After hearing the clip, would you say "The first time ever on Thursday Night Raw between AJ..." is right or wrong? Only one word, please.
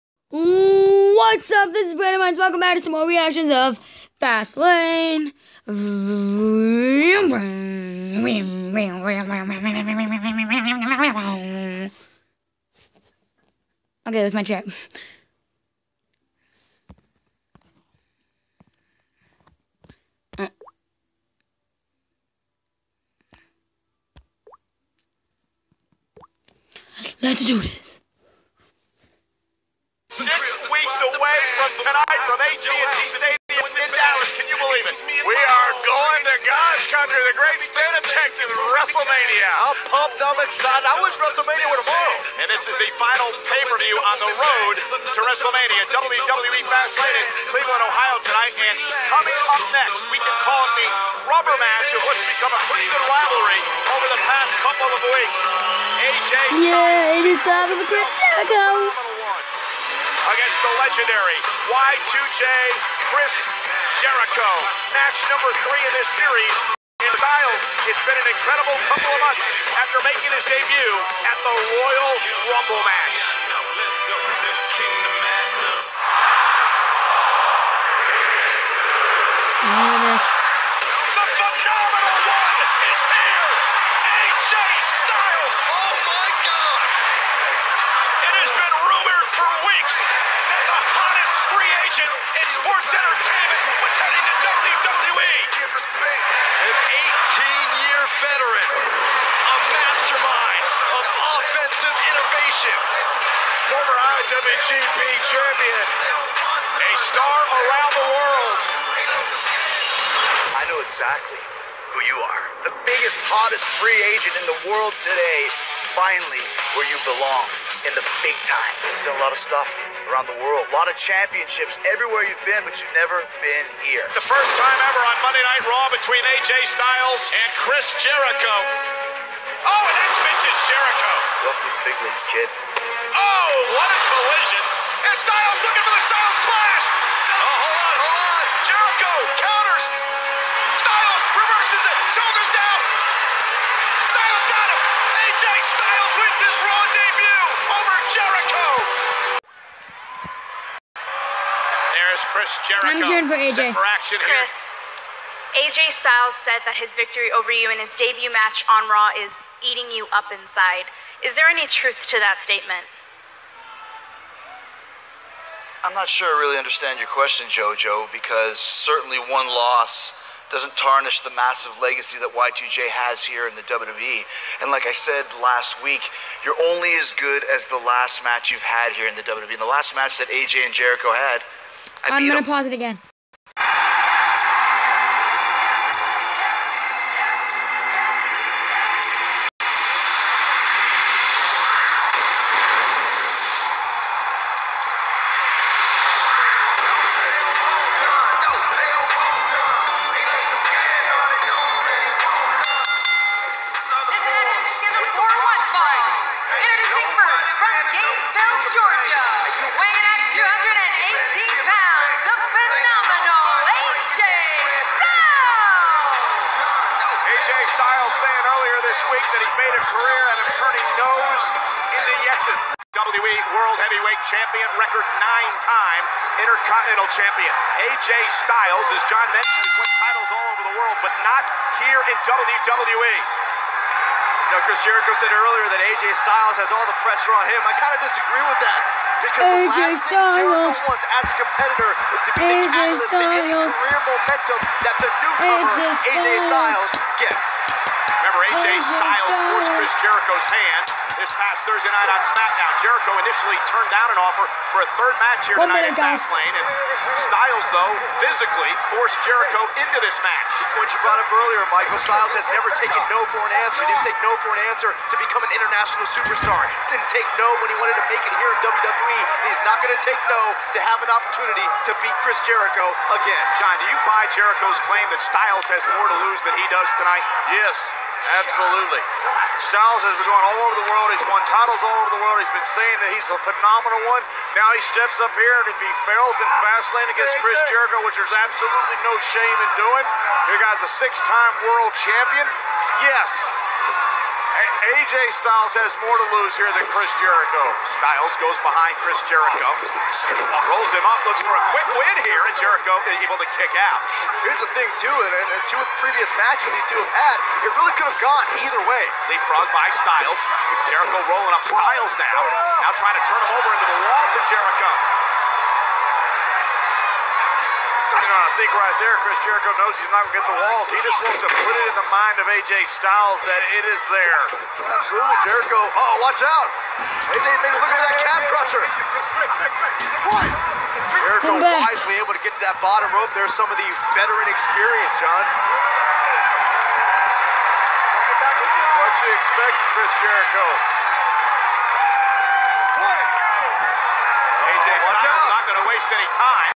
wrong.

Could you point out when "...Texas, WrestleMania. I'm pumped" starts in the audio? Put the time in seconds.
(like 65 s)
38 s.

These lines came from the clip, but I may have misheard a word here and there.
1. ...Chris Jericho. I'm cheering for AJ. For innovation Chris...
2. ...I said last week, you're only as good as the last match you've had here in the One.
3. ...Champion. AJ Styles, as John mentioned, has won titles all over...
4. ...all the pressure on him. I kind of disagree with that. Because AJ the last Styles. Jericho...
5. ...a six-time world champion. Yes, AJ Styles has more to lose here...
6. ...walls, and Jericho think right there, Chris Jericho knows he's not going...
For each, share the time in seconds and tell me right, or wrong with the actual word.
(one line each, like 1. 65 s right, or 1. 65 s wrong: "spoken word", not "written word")
1. 152 s wrong: "action", not "innovation"
2. 174 s wrong: "WWE", not "One"
3. 227 s right
4. 236 s right
5. 290 s right
6. 314 s right.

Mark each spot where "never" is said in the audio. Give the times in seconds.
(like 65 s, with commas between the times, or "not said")
122 s, 262 s.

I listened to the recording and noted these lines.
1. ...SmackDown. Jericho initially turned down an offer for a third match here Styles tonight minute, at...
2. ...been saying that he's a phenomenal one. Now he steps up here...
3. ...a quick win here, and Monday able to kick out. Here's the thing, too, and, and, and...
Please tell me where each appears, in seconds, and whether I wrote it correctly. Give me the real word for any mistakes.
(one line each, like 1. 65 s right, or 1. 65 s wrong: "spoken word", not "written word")
1. 252 s wrong: "One", not "Styles"
2. 282 s right
3. 301 s wrong: "Jericho", not "Monday".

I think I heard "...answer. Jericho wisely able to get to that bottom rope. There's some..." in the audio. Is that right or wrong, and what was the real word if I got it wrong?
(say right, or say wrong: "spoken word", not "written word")
wrong: "crusher", not "answer".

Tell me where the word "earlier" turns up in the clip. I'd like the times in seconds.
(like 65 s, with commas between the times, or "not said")
218 s, 235 s, 261 s.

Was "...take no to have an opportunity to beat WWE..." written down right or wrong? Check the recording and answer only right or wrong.
wrong.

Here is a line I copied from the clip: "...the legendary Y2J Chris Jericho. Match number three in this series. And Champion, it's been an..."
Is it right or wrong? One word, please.
wrong.